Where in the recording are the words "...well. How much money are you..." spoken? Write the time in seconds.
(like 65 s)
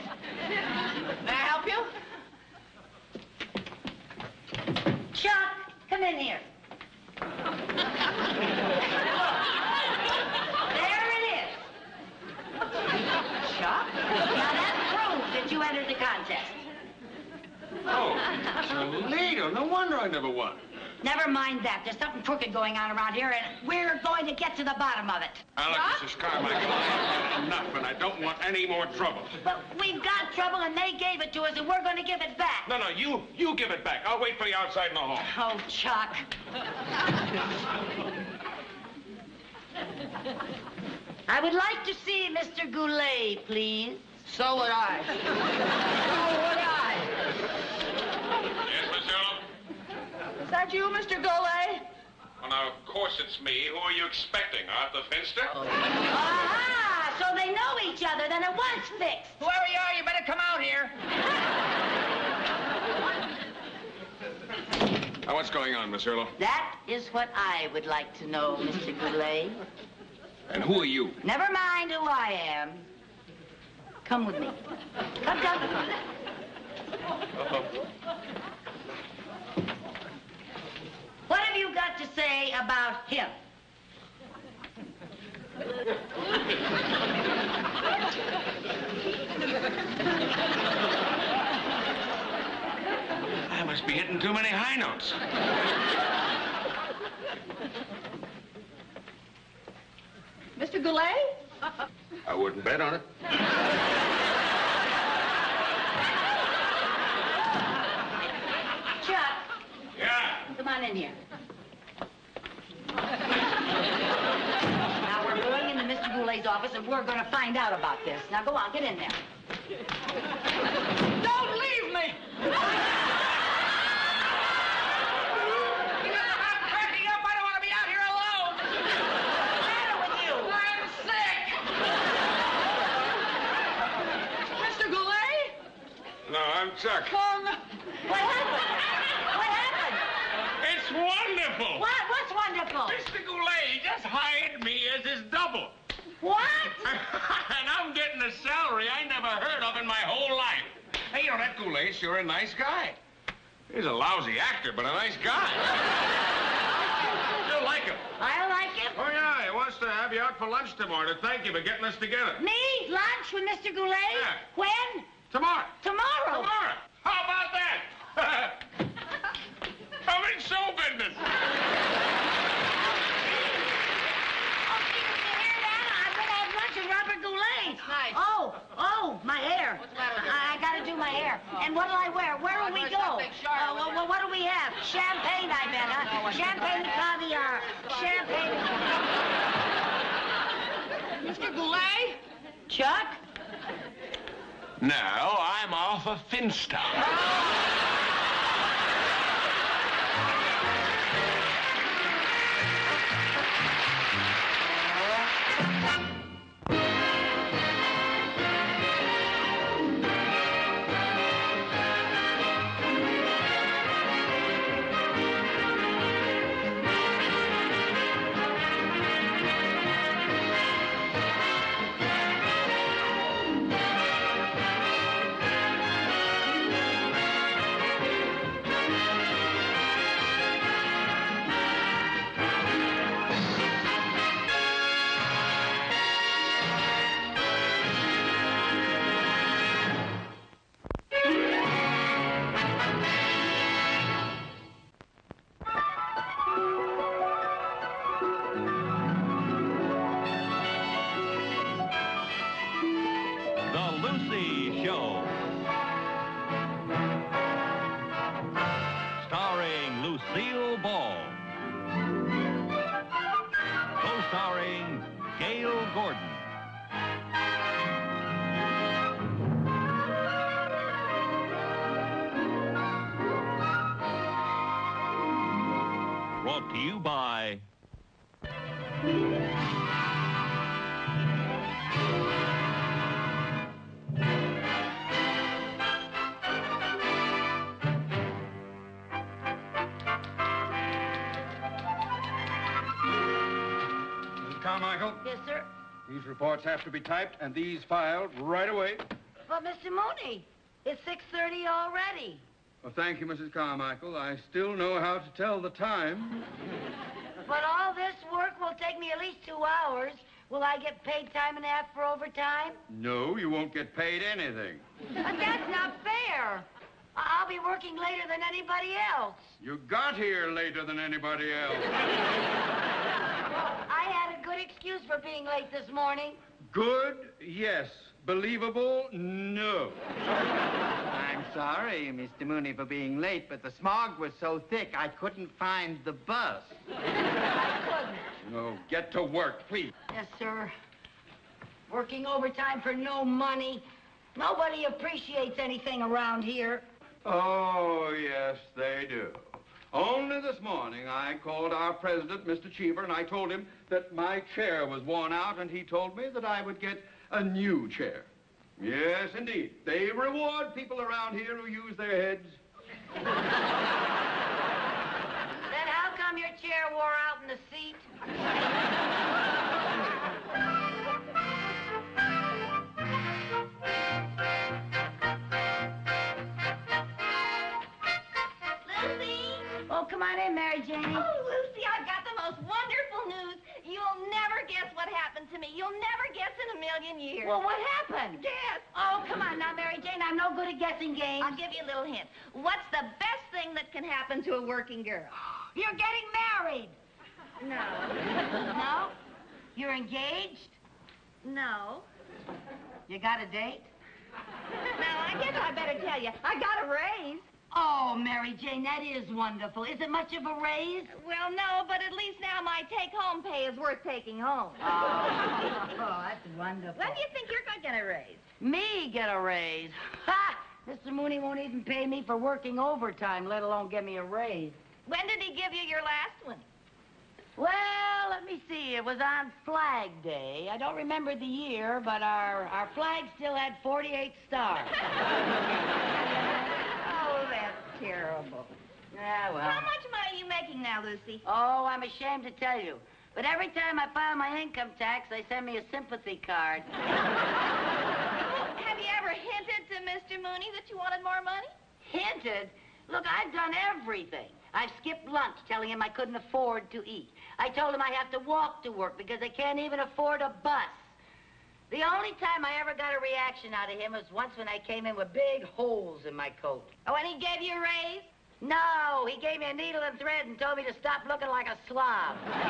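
439 s.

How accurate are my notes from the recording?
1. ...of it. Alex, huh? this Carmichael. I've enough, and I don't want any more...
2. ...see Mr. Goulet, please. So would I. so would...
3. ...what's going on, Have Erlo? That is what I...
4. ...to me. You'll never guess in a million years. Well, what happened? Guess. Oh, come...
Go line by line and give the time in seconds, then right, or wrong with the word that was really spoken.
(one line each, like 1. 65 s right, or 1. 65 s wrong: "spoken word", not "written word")
1. 25 s right
2. 42 s right
3. 65 s wrong: "Miss", not "Have"
4. 385 s right.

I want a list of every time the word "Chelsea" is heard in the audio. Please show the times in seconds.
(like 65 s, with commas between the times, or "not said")
not said.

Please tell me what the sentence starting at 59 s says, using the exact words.
Whoever you are, you better come out here.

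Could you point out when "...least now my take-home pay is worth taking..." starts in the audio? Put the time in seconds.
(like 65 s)
412 s.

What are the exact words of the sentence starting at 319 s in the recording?
You got here later than anybody else.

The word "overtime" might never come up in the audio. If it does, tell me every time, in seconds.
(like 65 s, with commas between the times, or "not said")
312 s, 342 s, 422 s.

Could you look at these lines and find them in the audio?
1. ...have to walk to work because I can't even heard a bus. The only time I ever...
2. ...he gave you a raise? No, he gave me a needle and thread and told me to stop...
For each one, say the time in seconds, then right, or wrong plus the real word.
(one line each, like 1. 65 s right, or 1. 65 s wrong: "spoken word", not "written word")
1. 458 s wrong: "afford", not "heard"
2. 467 s right.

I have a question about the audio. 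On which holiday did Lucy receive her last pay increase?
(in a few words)
Flag Day.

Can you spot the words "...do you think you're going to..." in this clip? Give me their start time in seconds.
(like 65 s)
417 s.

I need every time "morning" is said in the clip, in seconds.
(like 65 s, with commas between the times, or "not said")
325 s, 350 s.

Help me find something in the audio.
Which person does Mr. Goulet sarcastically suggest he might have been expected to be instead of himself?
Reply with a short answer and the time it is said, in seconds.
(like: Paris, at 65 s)
Arthur Finster, at 54 s.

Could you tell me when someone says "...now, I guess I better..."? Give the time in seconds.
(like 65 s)
404 s.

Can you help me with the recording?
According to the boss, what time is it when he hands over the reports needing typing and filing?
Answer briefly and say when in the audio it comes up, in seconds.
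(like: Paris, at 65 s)
6:30, at 301 s.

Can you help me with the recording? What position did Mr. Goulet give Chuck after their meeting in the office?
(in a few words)
his double.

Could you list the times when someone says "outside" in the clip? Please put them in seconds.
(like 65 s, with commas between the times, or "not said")
34 s.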